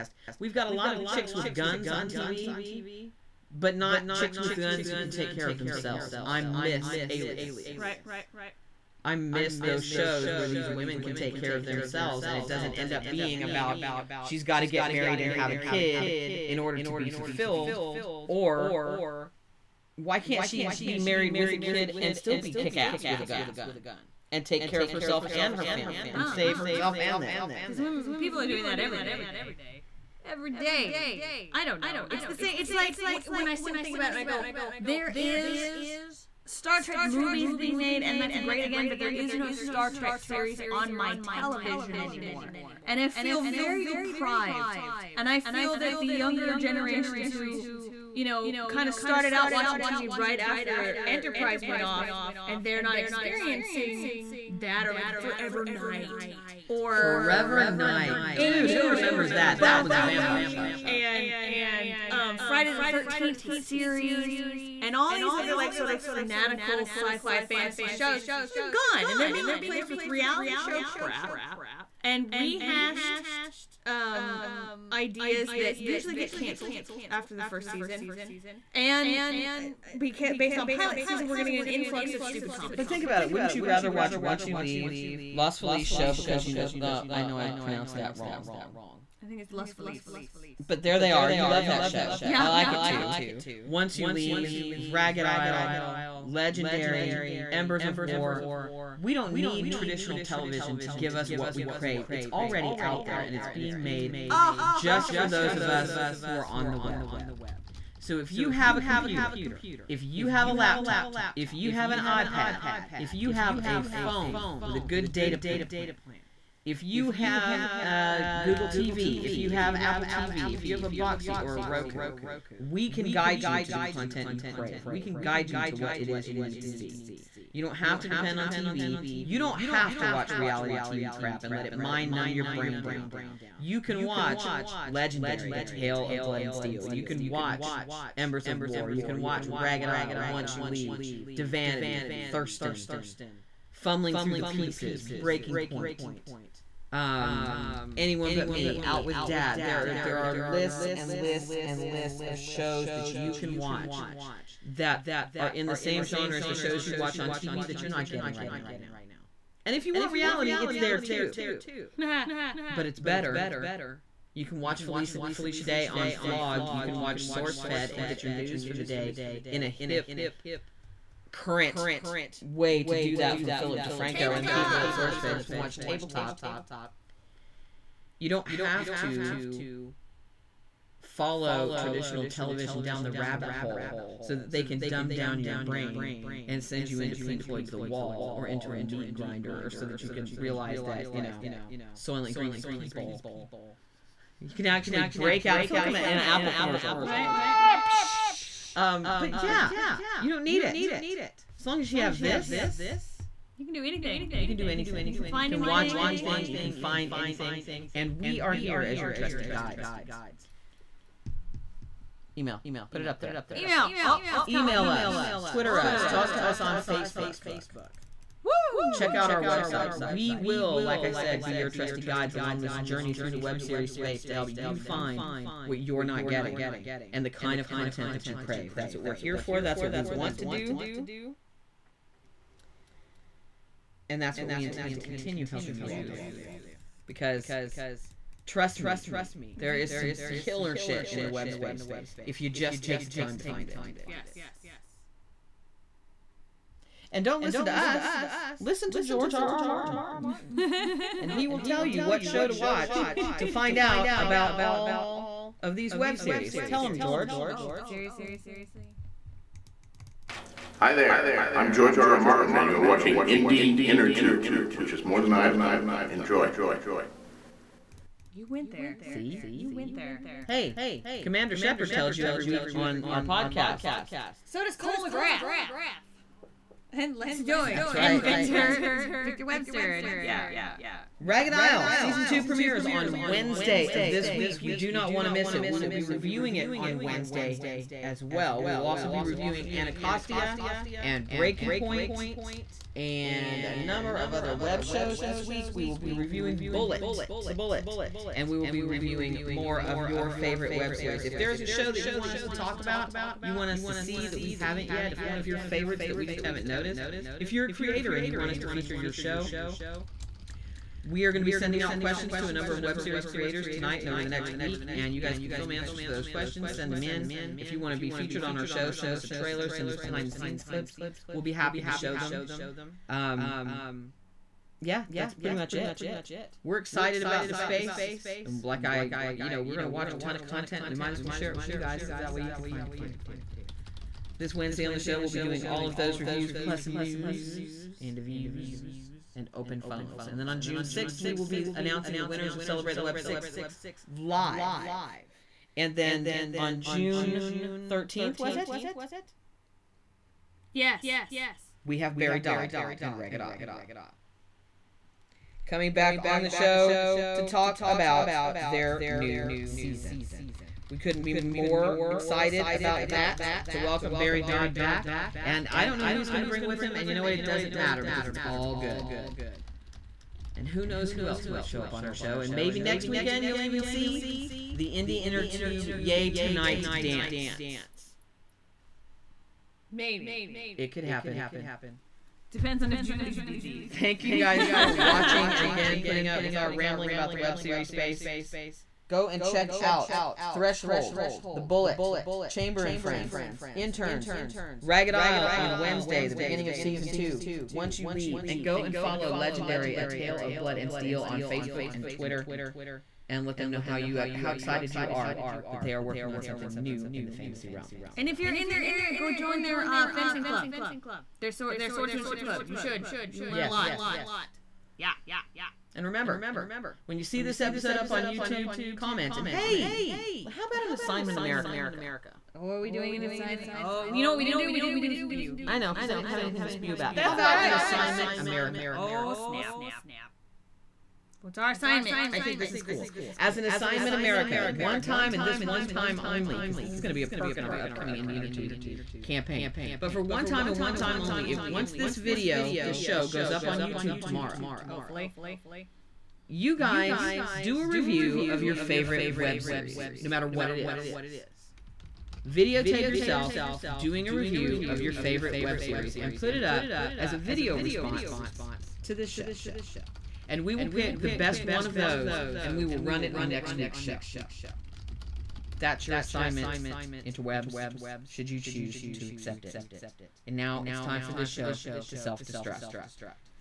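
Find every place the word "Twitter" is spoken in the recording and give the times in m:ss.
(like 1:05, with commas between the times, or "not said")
3:35, 6:42.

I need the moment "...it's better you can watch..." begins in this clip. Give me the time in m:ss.
2:42.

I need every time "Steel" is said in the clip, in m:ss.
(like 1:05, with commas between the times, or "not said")
2:16, 6:40.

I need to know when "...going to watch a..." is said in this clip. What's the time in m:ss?
5:29.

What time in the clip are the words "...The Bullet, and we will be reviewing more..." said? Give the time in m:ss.
4:57.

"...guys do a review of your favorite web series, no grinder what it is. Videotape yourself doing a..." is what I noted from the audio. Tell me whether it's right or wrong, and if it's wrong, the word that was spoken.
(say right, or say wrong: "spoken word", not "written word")
wrong: "matter", not "grinder".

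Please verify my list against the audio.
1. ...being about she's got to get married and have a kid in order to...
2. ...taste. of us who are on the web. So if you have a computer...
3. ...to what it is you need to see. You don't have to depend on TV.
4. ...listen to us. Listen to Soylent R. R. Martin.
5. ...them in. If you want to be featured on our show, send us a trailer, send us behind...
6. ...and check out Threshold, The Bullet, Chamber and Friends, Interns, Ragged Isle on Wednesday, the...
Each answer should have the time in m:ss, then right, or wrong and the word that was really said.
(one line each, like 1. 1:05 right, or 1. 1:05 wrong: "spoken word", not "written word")
1. 0:13 right
2. 1:45 right
3. 2:05 right
4. 4:07 wrong: "George", not "Soylent"
5. 5:16 right
6. 6:29 right.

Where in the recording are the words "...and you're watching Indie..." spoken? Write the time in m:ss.
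4:22.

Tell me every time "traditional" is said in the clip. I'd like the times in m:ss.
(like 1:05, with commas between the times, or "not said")
1:39, 3:01.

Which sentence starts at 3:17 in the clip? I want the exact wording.
Ah, um, but yeah, you don't need it.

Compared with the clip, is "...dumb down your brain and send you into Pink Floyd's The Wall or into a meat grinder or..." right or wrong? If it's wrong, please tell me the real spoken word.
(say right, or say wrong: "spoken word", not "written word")
right.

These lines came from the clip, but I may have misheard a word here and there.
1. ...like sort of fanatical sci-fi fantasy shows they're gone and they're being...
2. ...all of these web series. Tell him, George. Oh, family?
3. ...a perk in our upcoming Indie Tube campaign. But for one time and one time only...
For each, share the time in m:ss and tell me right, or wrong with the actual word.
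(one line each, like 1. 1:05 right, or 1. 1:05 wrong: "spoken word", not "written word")
1. 1:05 right
2. 4:14 wrong: "seriously", not "family"
3. 7:17 right.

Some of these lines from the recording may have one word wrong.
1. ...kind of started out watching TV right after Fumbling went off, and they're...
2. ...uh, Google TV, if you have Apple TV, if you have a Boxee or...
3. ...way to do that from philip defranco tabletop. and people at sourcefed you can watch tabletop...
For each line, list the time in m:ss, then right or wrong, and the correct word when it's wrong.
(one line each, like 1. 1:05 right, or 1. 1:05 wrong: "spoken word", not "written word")
1. 0:48 wrong: "Enterprise", not "Fumbling"
2. 1:57 right
3. 2:52 right.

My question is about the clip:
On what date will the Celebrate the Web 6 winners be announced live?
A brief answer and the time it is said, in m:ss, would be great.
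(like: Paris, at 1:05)
June 6, at 5:40.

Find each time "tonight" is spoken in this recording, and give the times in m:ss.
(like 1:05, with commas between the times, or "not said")
5:13, 6:16.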